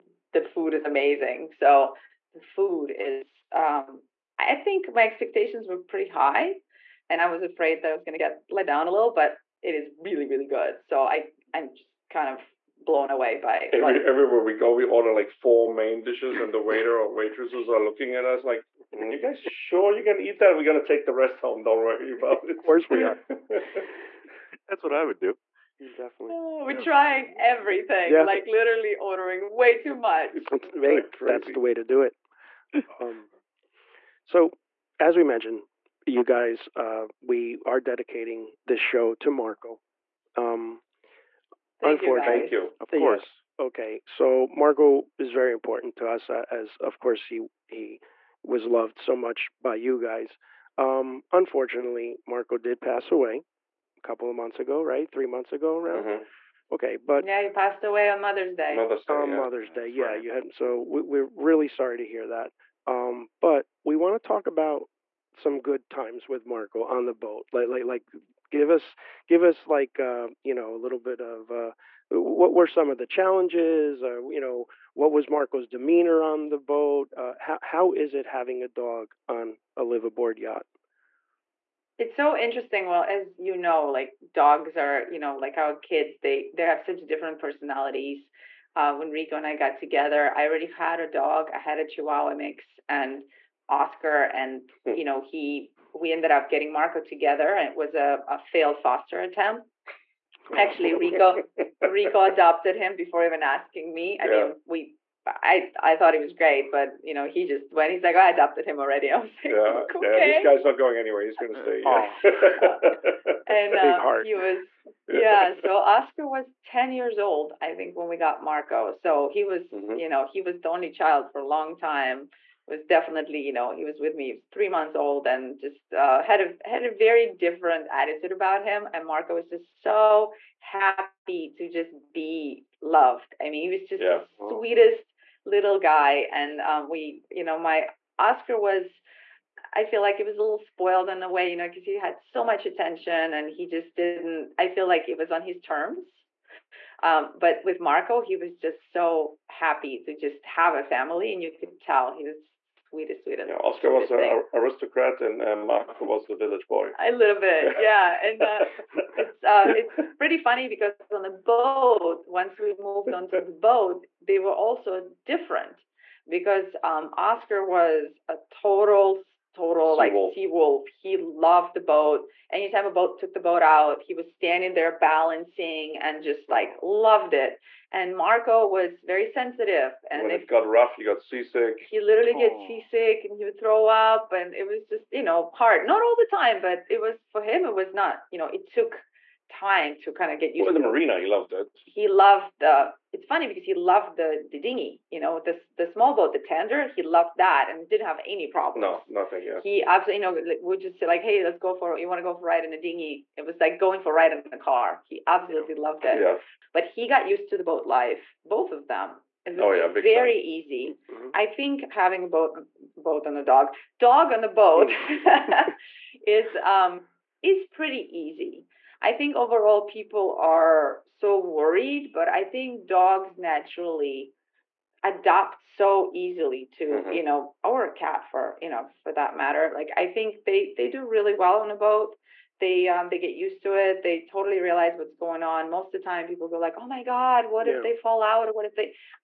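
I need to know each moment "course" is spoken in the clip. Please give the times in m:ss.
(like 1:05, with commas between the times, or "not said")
0:22, 0:42, 0:46.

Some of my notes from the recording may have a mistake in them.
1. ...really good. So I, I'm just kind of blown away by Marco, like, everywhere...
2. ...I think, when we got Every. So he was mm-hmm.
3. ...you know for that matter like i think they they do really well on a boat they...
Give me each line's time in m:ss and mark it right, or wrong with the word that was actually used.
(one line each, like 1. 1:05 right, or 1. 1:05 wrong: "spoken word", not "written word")
1. 0:10 wrong: "Every", not "Marco"
2. 1:57 wrong: "Marco", not "Every"
3. 3:48 right.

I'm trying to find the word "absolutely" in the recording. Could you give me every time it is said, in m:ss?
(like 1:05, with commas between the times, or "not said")
3:19, 3:25.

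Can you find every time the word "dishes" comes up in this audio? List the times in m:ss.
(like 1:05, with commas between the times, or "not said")
0:16.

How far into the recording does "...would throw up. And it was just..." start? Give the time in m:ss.
3:03.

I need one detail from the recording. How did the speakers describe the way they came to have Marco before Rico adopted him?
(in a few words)
A failed foster attempt.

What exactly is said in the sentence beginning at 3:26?
but he got used to the boat life both of them it was oh, yeah, very time.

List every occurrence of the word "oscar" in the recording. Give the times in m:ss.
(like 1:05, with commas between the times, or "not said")
1:33, 1:55, 2:18, 2:33, 2:47.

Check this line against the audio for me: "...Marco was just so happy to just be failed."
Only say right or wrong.
wrong.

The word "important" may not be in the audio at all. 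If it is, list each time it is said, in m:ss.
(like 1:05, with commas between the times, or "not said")
0:45.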